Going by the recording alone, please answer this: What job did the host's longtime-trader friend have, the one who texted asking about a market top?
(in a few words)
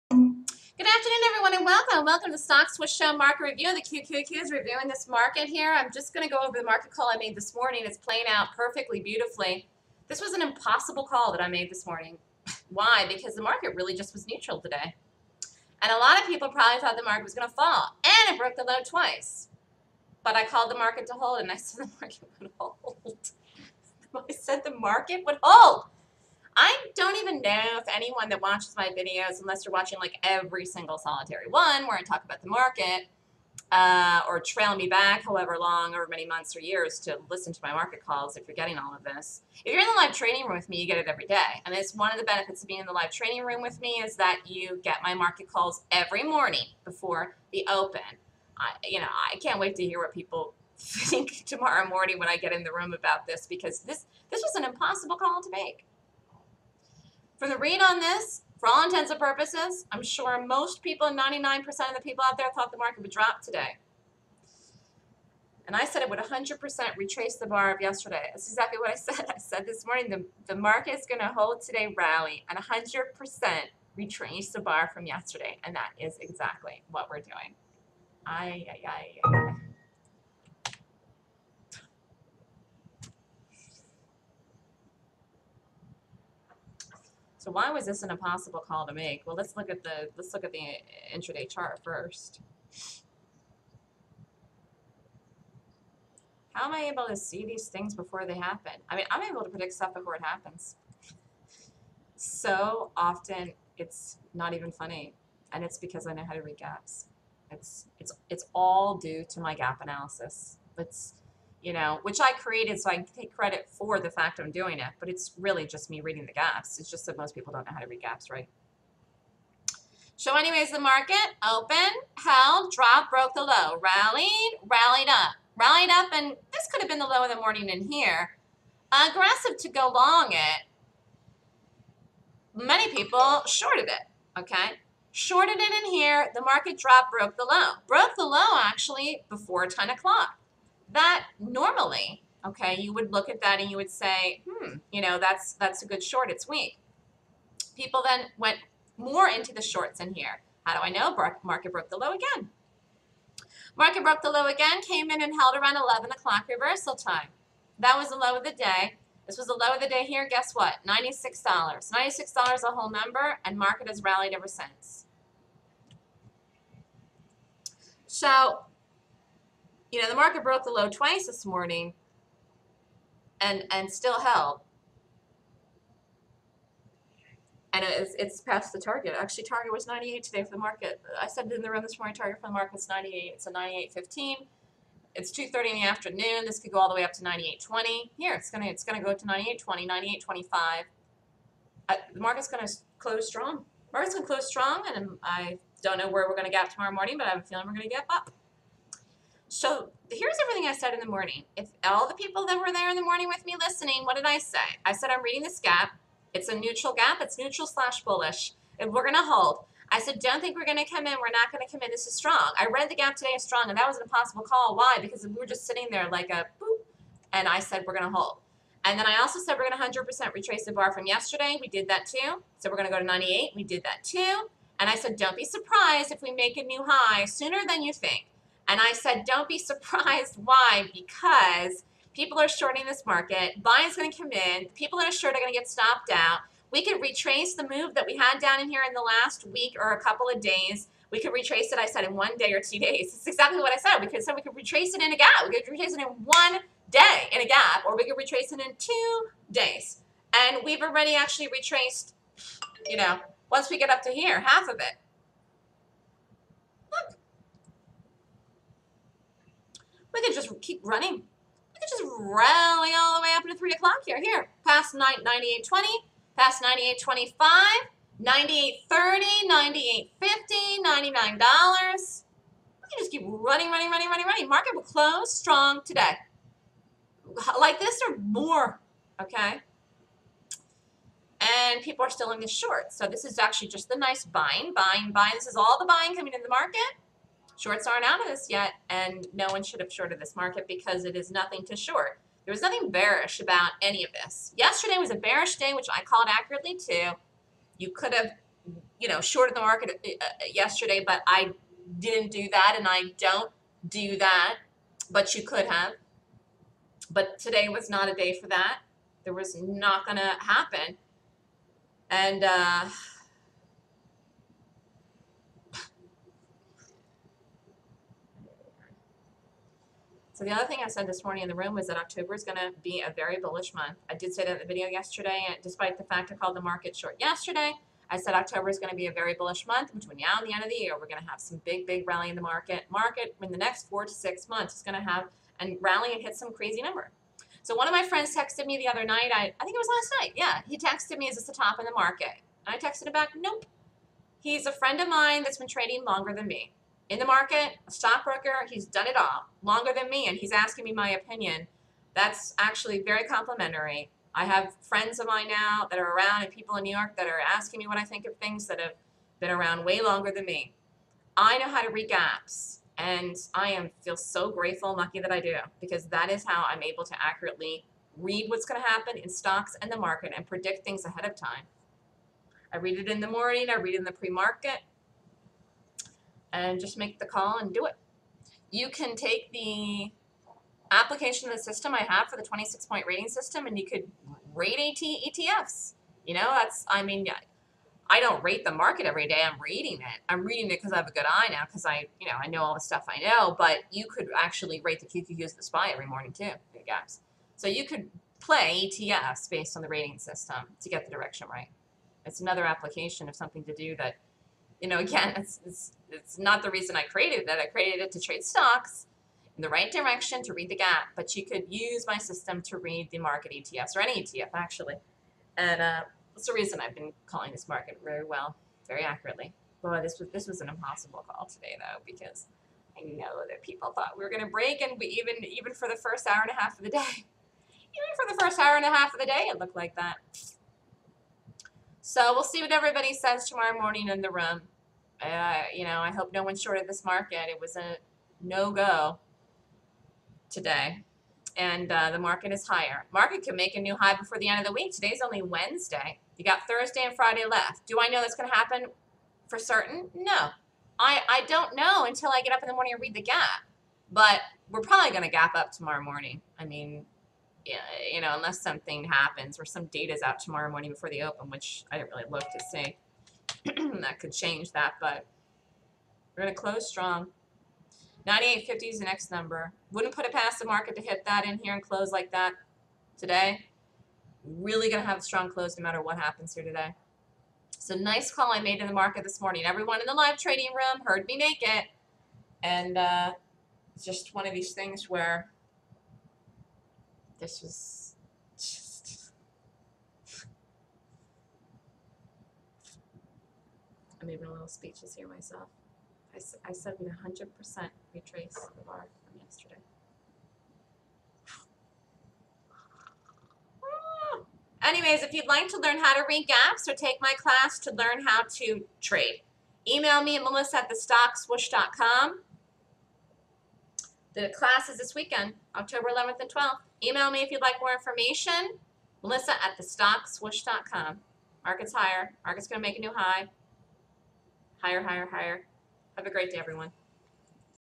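stockbroker.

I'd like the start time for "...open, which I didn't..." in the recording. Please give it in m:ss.
7:41.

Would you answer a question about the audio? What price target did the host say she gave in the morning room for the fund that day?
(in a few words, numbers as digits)
98.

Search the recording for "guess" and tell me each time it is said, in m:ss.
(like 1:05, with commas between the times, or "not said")
2:40, 6:36.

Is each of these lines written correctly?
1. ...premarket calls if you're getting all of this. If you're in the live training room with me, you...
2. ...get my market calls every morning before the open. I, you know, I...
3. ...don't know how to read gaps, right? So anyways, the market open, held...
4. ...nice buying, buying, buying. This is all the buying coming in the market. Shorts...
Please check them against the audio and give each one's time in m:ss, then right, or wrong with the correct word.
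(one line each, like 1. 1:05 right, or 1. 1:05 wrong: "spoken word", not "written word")
1. 0:37 wrong: "market", not "premarket"
2. 0:44 right
3. 1:57 right
4. 4:43 right.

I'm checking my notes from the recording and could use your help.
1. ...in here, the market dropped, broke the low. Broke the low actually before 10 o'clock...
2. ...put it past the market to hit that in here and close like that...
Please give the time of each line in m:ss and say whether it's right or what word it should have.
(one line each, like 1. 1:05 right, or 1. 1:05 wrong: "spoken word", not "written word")
1. 2:15 right
2. 7:50 right.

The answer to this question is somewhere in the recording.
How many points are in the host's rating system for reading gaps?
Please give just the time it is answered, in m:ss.
6:22.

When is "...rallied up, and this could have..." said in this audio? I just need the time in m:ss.
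2:05.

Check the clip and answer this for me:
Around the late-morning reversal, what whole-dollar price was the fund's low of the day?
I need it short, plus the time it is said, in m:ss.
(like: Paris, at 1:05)
$96, at 2:41.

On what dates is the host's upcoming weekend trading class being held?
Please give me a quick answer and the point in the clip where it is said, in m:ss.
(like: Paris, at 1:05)
October 11 and 12, at 8:35.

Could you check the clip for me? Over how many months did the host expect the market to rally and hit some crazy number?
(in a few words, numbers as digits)
4 to 6 months.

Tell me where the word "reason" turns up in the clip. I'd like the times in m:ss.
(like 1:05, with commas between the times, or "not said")
6:46, 6:56.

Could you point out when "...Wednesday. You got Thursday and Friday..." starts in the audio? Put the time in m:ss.
7:25.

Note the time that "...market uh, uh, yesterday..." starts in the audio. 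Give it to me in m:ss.
4:59.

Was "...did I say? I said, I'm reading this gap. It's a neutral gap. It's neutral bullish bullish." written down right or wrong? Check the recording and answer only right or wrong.
wrong.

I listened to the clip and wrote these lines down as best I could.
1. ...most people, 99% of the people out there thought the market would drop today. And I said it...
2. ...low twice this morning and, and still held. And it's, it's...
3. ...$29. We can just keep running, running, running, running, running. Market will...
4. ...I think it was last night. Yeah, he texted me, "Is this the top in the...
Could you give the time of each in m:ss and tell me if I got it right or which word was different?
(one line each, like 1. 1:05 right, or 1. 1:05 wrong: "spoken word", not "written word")
1. 1:00 right
2. 2:50 right
3. 4:30 wrong: "99", not "29"
4. 5:39 right.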